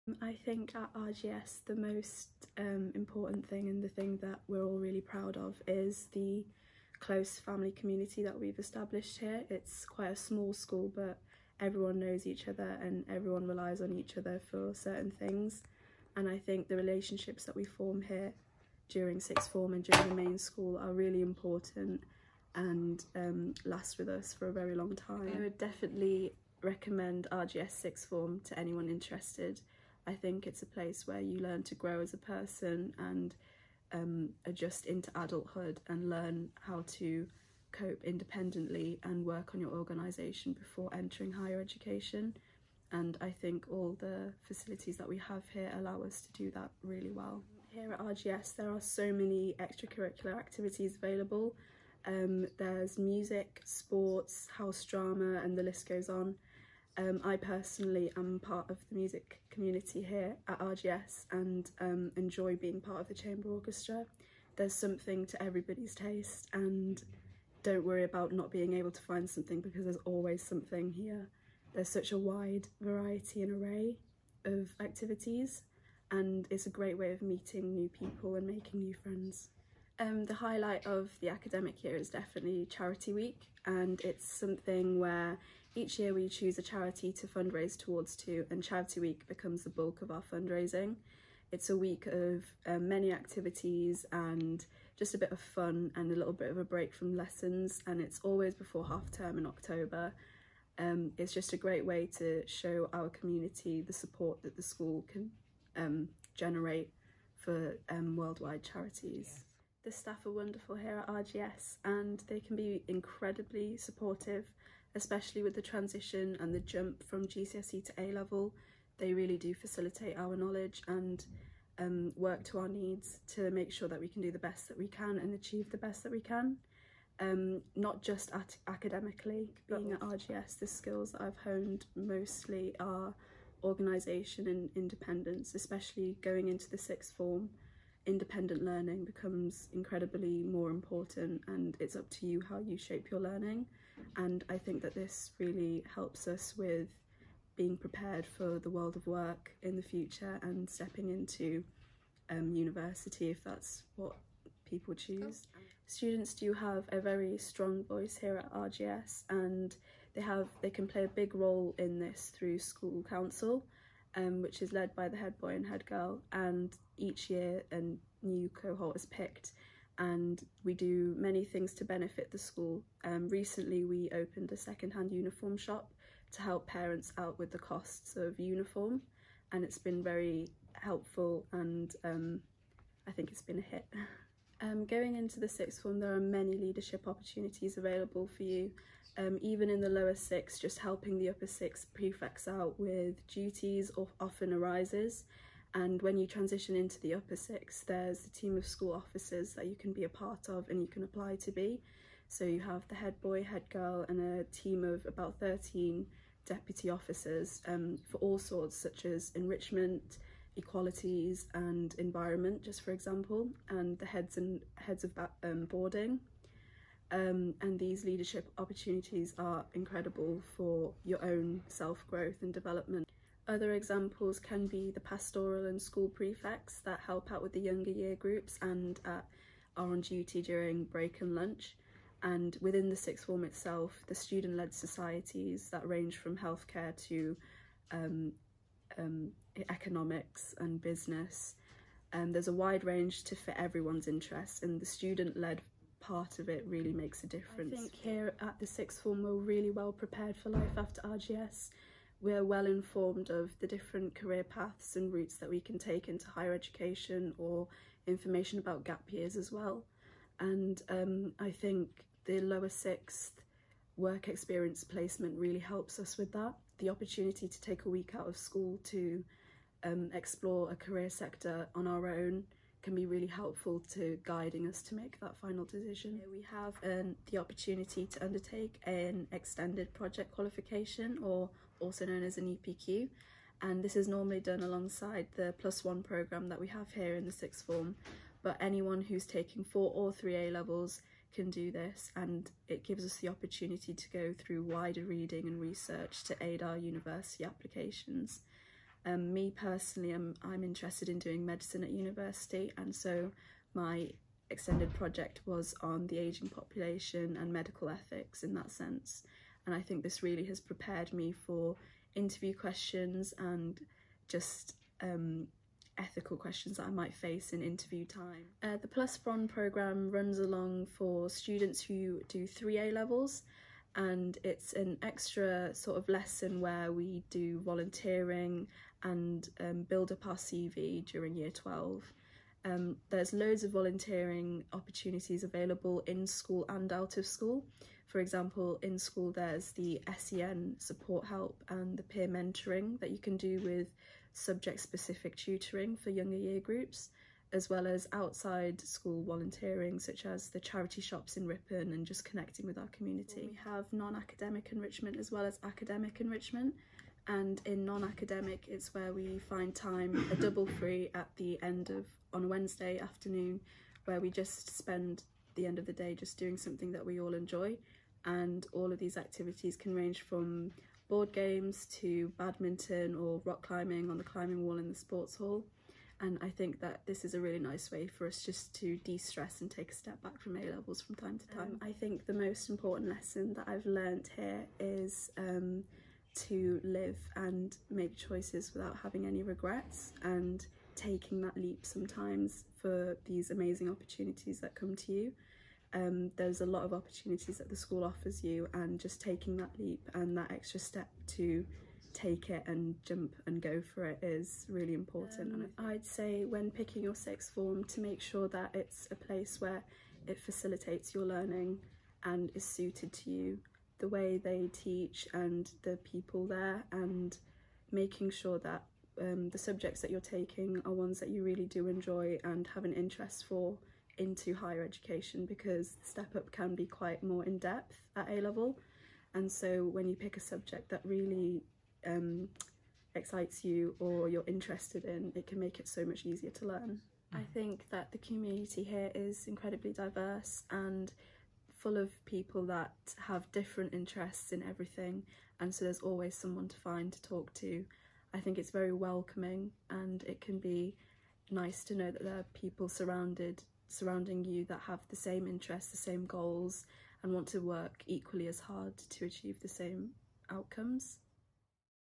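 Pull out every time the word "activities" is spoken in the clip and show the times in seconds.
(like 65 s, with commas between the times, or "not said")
50 s, 74 s, 93 s, 369 s.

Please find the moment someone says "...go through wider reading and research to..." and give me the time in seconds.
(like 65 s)
294 s.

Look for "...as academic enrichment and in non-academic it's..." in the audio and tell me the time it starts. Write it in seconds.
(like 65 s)
355 s.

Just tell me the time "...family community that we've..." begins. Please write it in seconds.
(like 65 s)
7 s.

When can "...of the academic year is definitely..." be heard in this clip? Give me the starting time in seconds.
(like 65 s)
80 s.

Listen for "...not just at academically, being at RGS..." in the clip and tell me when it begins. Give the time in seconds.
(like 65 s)
127 s.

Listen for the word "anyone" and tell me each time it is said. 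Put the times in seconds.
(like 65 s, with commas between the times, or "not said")
28 s, 288 s.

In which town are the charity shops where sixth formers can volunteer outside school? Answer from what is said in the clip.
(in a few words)
Ripon.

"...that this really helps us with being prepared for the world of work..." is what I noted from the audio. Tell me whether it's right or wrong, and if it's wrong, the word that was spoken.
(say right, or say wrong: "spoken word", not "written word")
right.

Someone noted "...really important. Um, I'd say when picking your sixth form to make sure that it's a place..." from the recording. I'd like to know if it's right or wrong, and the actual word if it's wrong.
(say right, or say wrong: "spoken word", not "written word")
right.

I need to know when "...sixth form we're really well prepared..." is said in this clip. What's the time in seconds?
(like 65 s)
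248 s.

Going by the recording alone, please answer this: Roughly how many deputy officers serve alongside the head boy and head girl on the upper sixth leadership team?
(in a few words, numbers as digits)
13.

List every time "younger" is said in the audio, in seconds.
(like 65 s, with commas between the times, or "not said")
227 s, 346 s.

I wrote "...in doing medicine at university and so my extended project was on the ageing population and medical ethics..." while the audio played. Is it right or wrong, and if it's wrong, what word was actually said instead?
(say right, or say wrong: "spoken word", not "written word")
right.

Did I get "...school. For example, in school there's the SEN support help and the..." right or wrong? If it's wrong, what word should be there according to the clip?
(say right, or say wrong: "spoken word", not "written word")
right.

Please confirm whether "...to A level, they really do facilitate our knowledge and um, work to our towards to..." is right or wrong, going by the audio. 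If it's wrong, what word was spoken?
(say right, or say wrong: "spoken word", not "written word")
wrong: "needs", not "towards".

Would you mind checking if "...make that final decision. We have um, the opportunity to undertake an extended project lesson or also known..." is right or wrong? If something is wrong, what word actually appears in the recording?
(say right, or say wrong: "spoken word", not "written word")
wrong: "qualification", not "lesson".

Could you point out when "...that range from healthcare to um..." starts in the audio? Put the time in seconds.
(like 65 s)
235 s.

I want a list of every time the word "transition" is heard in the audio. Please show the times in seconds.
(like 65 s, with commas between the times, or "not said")
115 s, 196 s.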